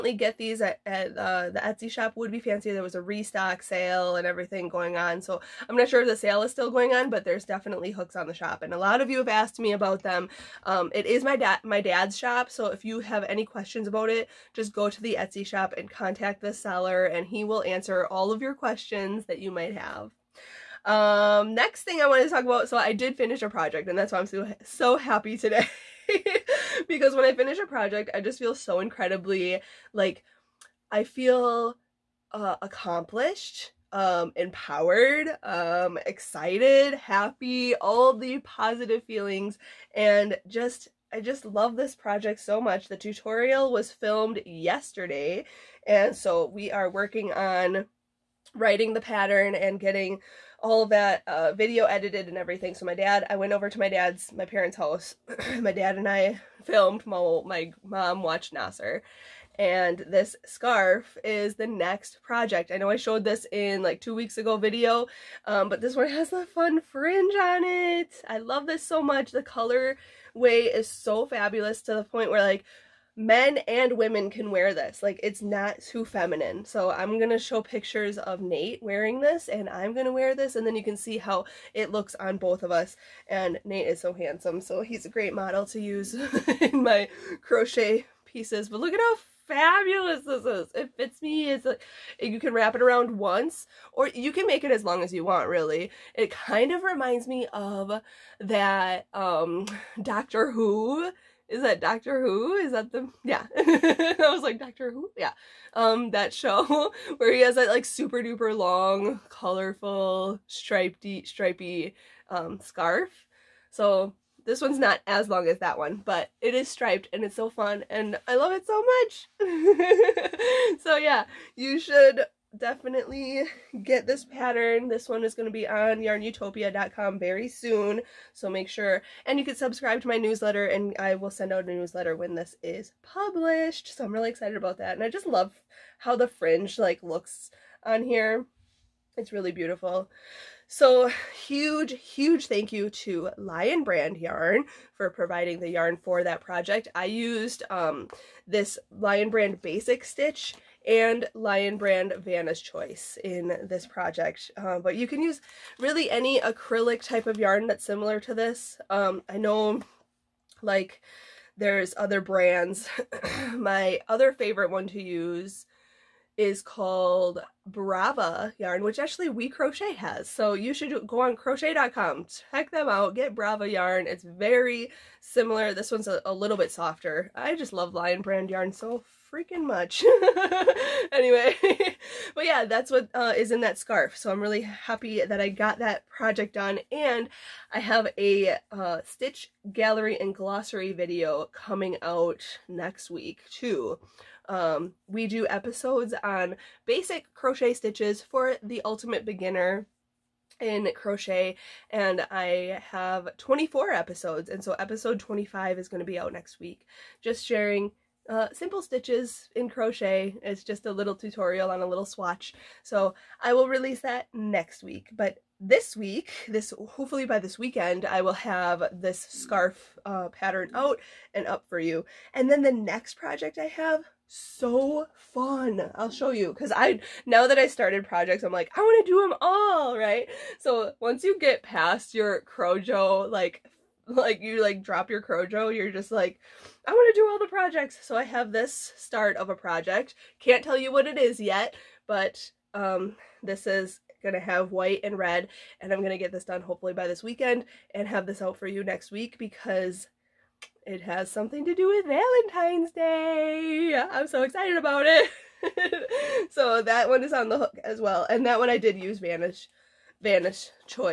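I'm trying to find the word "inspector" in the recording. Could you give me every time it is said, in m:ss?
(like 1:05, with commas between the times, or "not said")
not said.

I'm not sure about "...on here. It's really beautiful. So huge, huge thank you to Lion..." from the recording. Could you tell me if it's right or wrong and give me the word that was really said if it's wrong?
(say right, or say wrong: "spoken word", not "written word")
right.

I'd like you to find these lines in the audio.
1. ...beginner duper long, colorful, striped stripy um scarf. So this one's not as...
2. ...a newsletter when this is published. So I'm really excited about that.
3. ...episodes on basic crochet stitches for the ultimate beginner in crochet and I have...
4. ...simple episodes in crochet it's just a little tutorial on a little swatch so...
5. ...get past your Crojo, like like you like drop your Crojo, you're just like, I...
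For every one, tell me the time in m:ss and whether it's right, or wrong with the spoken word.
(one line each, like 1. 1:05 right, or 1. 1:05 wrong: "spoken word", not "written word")
1. 1:47 wrong: "super", not "beginner"
2. 2:11 right
3. 3:15 right
4. 3:28 wrong: "stitches", not "episodes"
5. 3:51 right.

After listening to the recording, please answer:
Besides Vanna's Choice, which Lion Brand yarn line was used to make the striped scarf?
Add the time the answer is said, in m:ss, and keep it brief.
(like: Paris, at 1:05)
Basic Stitch, at 2:29.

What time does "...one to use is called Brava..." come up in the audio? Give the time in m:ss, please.
2:44.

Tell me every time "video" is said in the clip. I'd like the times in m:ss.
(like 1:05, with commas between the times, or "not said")
0:51, 1:04, 3:10.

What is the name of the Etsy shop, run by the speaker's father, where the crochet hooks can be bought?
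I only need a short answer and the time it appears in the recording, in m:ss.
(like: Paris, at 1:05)
Wood Be Fancy, at 0:02.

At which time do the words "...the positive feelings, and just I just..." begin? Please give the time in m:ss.
0:38.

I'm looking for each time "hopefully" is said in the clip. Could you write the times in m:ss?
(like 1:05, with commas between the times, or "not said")
3:36, 4:06.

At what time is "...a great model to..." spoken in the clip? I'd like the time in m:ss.
1:25.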